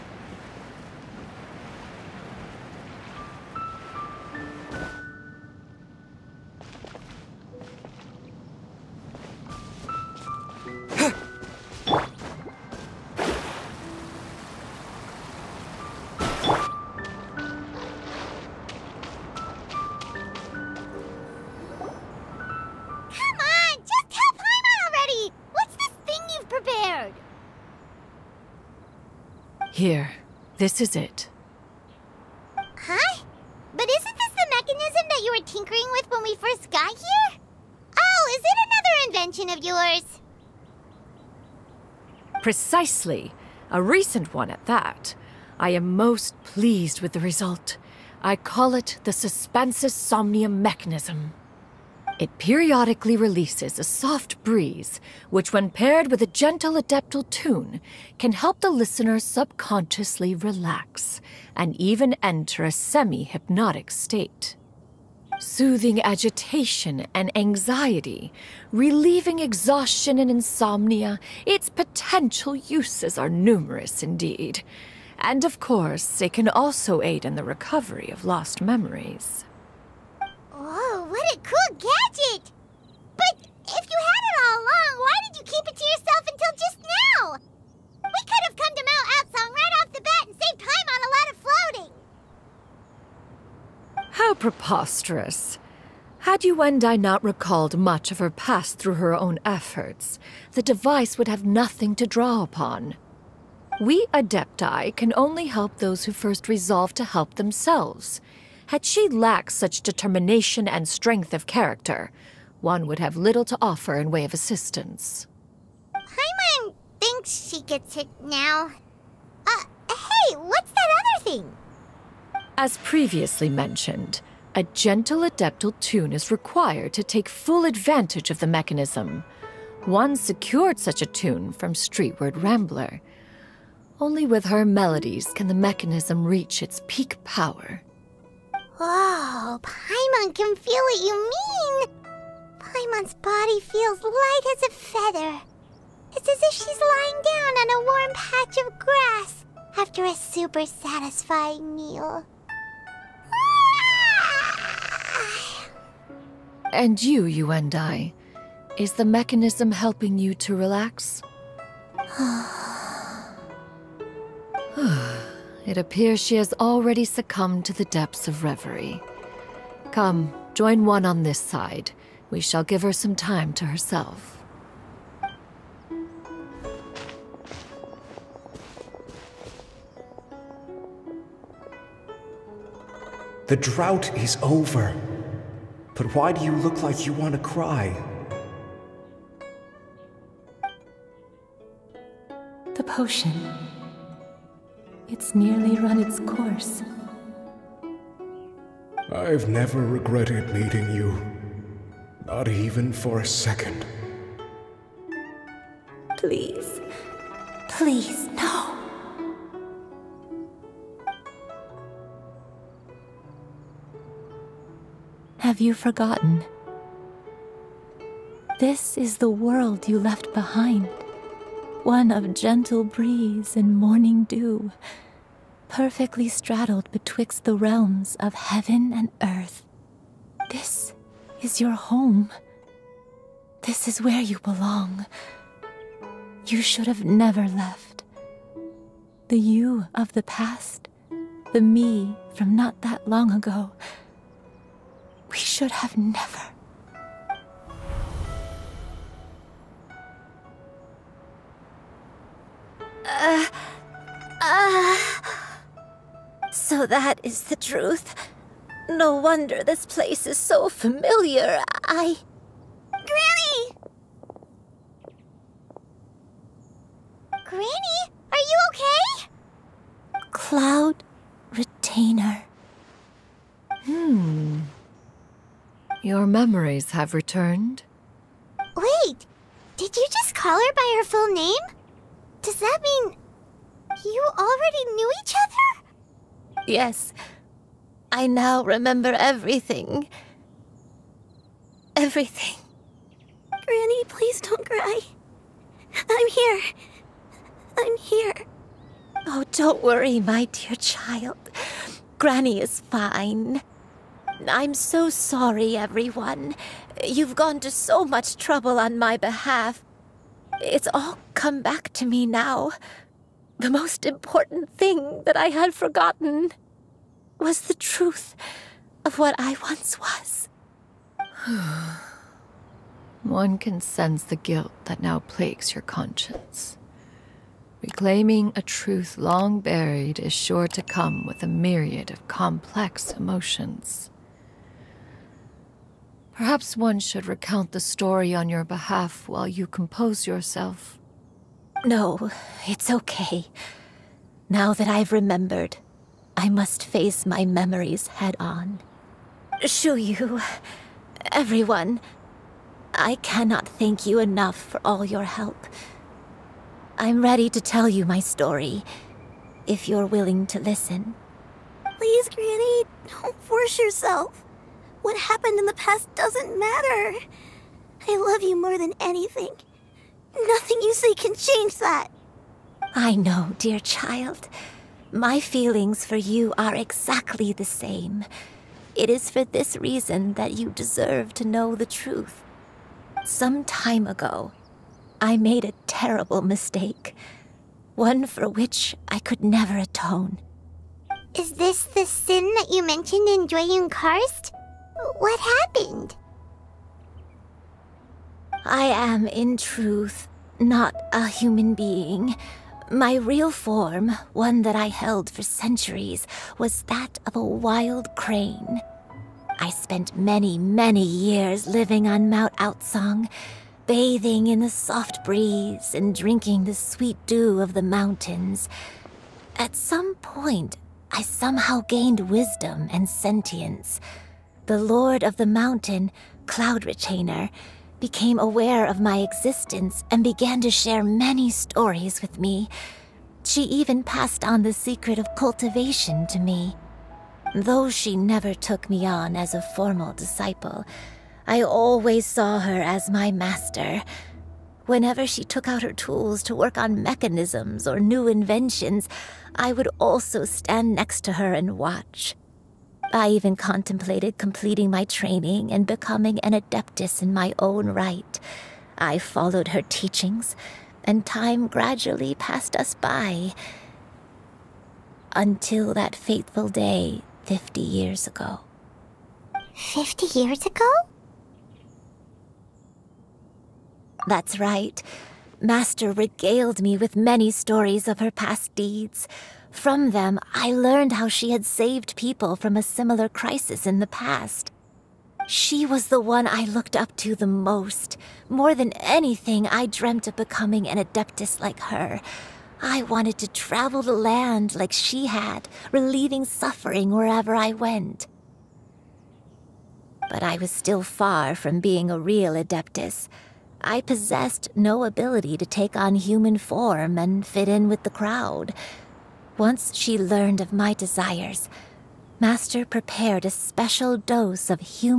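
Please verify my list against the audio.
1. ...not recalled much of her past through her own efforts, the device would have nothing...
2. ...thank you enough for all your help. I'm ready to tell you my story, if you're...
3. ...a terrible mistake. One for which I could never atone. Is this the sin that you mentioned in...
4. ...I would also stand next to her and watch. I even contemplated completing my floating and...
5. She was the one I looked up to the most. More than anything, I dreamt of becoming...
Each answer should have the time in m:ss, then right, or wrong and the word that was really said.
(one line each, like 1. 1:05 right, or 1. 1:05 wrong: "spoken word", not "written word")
1. 1:36 right
2. 5:53 right
3. 6:25 right
4. 7:29 wrong: "training", not "floating"
5. 8:05 right.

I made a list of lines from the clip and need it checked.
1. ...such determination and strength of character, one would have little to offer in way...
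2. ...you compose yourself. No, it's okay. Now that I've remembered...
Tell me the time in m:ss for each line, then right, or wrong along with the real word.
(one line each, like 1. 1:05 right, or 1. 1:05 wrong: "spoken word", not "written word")
1. 1:49 right
2. 5:39 right.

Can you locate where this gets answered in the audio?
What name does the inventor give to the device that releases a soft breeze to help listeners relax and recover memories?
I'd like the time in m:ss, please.
0:49.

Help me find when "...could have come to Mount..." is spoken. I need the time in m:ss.
1:28.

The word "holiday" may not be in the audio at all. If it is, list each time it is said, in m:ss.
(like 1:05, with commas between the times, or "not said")
not said.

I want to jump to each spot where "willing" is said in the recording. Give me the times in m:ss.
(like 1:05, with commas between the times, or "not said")
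6:00.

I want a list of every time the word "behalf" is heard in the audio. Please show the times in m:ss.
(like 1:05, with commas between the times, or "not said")
5:09, 5:38.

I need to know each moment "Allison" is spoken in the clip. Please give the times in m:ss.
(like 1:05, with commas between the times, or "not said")
not said.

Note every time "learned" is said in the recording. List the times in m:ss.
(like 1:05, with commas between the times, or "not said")
8:00, 8:30.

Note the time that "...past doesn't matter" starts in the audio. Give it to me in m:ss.
6:05.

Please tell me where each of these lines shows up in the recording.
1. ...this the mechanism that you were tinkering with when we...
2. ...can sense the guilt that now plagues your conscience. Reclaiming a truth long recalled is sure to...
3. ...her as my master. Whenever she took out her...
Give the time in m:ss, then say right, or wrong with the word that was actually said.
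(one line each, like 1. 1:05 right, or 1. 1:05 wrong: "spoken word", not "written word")
1. 0:34 right
2. 5:23 wrong: "buried", not "recalled"
3. 7:22 right.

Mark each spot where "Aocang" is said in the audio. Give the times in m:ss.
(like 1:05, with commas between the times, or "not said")
1:29, 6:52.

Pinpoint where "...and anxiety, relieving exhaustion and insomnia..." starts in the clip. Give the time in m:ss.
1:07.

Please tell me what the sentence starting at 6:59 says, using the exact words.
At some point, I somehow gained wisdom and sentience.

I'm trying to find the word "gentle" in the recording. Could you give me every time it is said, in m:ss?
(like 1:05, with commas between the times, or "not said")
0:56, 2:04, 3:42.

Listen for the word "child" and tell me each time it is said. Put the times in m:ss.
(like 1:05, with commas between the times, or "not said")
5:00, 6:13.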